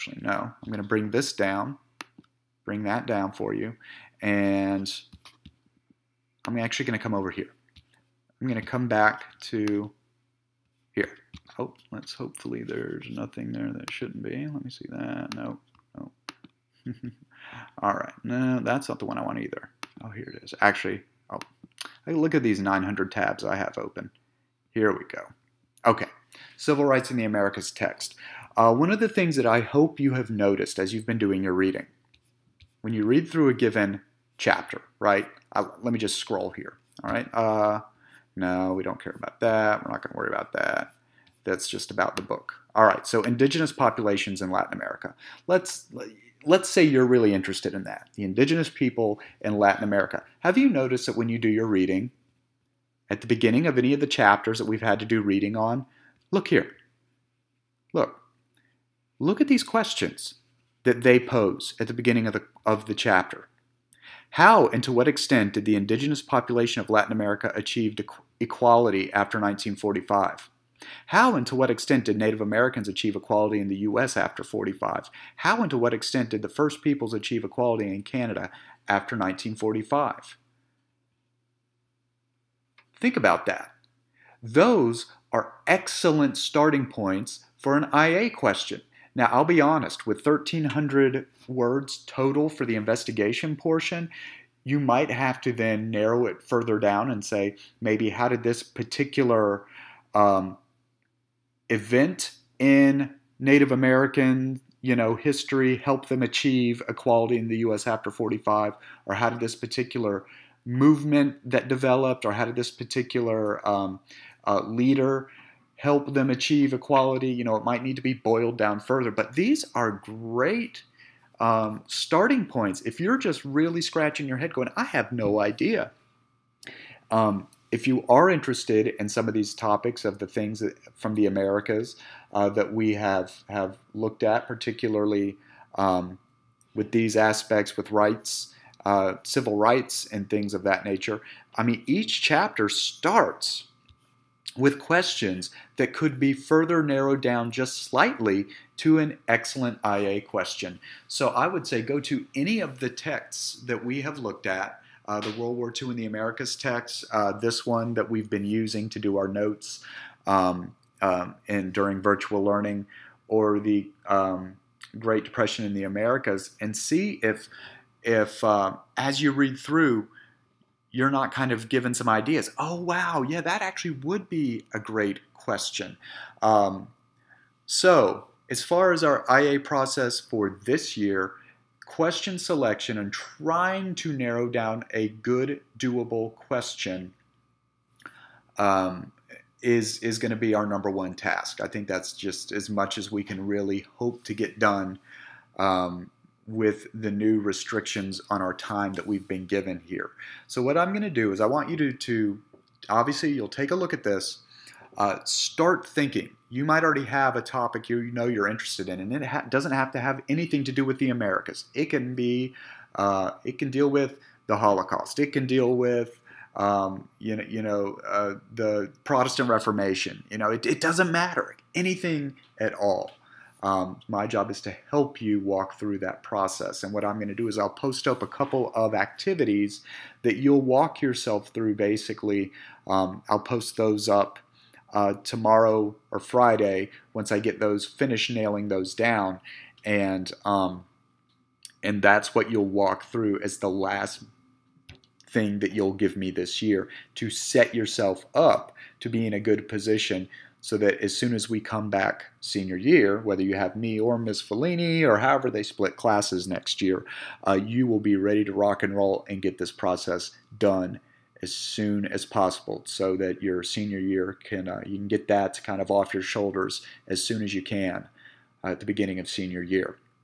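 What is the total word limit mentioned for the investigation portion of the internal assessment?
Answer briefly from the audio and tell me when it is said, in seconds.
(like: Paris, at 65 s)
1300, at 90 s.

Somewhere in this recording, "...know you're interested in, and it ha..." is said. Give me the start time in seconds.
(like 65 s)
208 s.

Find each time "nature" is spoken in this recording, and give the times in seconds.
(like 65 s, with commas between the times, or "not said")
140 s.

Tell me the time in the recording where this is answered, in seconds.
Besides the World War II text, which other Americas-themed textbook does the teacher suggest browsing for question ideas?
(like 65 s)
164 s.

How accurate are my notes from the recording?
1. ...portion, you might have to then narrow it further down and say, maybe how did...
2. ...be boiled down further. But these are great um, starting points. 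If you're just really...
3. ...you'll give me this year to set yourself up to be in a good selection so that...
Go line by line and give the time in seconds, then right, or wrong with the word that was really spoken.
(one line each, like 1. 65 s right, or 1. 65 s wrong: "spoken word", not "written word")
1. 93 s right
2. 118 s right
3. 245 s wrong: "position", not "selection".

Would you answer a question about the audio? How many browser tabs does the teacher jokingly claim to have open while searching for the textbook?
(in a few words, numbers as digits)
900.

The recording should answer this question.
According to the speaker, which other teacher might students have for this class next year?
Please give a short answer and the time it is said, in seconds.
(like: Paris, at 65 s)
Ms. Fellini, at 254 s.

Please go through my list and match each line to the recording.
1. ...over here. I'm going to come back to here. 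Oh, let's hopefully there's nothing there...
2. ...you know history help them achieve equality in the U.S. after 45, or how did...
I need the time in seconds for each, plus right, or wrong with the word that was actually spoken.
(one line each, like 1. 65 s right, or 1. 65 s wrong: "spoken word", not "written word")
1. 7 s right
2. 104 s right.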